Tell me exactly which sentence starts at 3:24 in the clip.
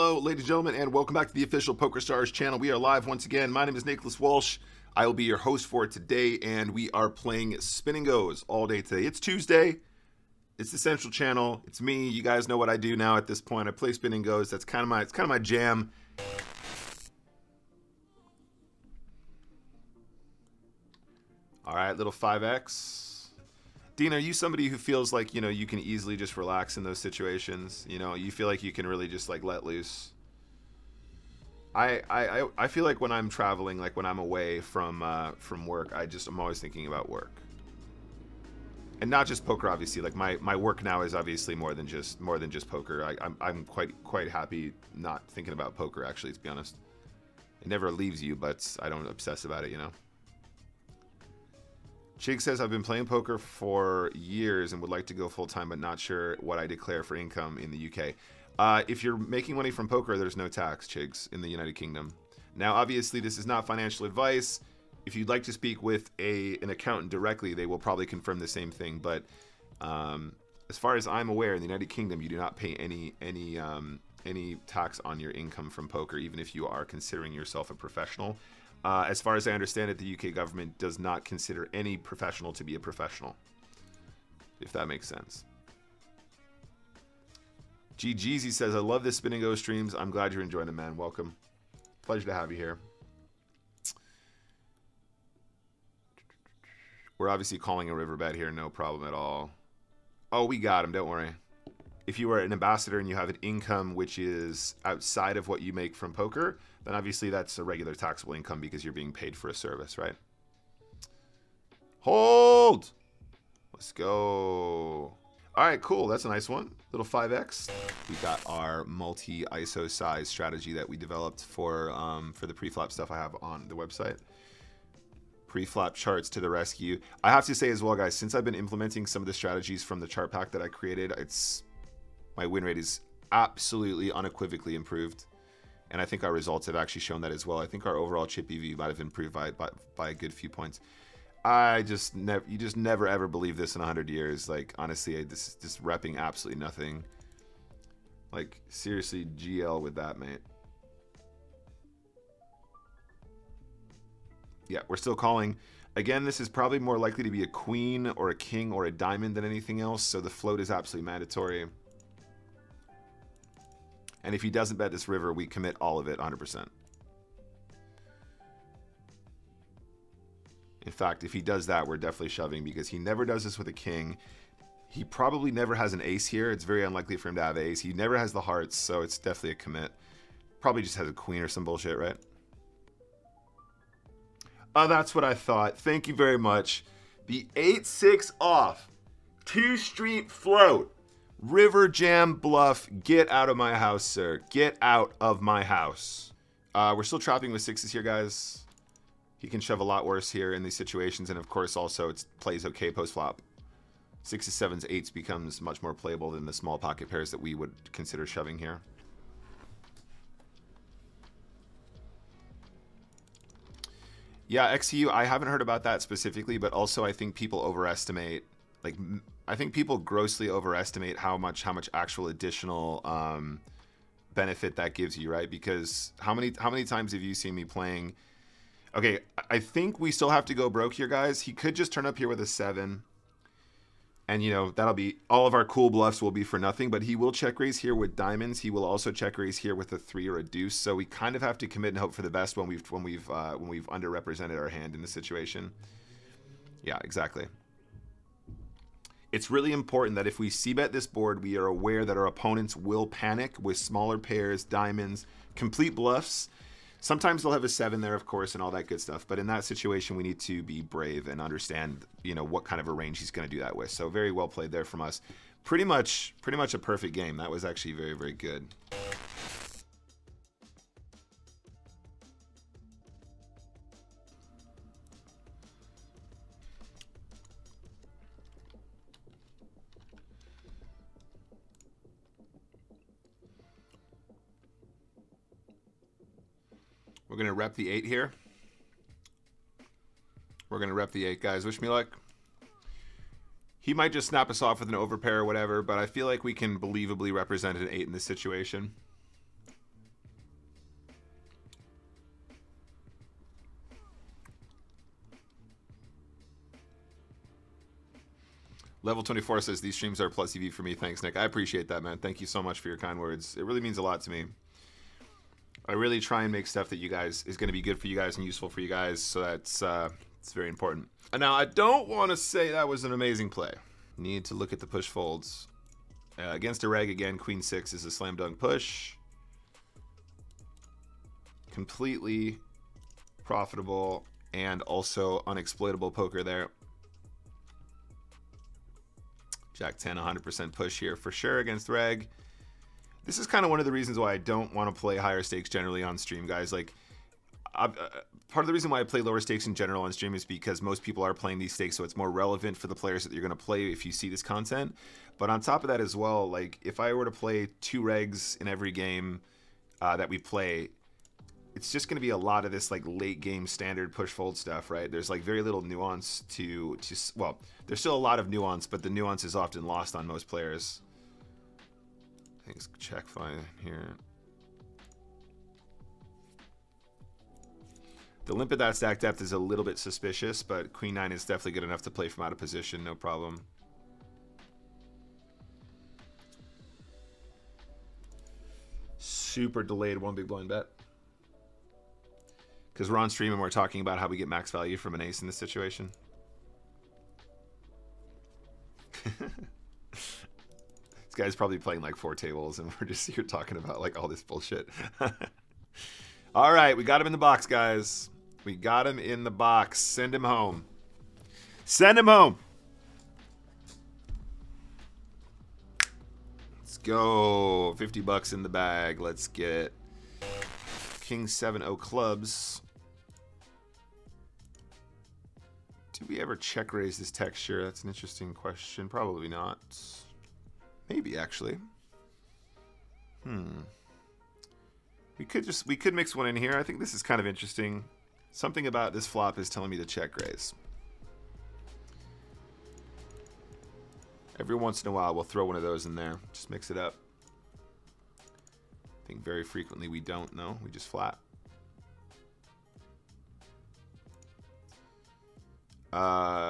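Sixes, sevens, eights becomes much more playable than the small pocket pairs that we would consider shoving here.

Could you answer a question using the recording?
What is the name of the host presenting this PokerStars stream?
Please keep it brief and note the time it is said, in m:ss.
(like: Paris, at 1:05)
Nicholas Walsh, at 0:03.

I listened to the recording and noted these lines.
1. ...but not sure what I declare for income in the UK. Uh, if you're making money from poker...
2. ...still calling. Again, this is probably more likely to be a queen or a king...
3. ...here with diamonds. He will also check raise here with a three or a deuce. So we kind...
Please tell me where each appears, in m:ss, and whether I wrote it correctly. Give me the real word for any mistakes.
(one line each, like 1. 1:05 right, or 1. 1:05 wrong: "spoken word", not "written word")
1. 0:55 right
2. 2:34 right
3. 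3:57 right.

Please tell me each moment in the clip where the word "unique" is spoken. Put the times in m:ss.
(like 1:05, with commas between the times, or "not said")
not said.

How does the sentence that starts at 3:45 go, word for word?
Because how many how many times have you seen me playing?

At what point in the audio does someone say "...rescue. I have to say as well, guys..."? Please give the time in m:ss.
2:06.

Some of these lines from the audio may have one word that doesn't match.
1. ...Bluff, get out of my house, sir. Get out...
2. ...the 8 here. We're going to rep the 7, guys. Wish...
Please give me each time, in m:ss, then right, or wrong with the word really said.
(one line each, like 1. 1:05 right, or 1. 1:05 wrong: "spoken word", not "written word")
1. 3:12 right
2. 4:47 wrong: "8", not "7".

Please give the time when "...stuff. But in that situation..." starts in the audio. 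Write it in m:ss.
4:19.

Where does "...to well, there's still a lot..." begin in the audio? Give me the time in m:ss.
6:06.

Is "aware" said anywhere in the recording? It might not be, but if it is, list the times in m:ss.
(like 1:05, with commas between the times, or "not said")
1:11, 4:11.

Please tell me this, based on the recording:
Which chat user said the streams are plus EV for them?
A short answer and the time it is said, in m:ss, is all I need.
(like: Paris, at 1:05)
Level 24, at 5:09.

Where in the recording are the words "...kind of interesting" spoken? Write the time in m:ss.
7:17.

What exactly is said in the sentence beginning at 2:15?
And I think our results have actually shown that as well.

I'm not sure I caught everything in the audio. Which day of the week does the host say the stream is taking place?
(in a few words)
Tuesday.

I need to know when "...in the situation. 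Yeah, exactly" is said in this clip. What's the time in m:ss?
4:04.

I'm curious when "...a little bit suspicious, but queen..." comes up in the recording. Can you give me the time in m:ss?
6:19.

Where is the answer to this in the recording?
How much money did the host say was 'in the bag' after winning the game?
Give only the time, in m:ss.
6:57.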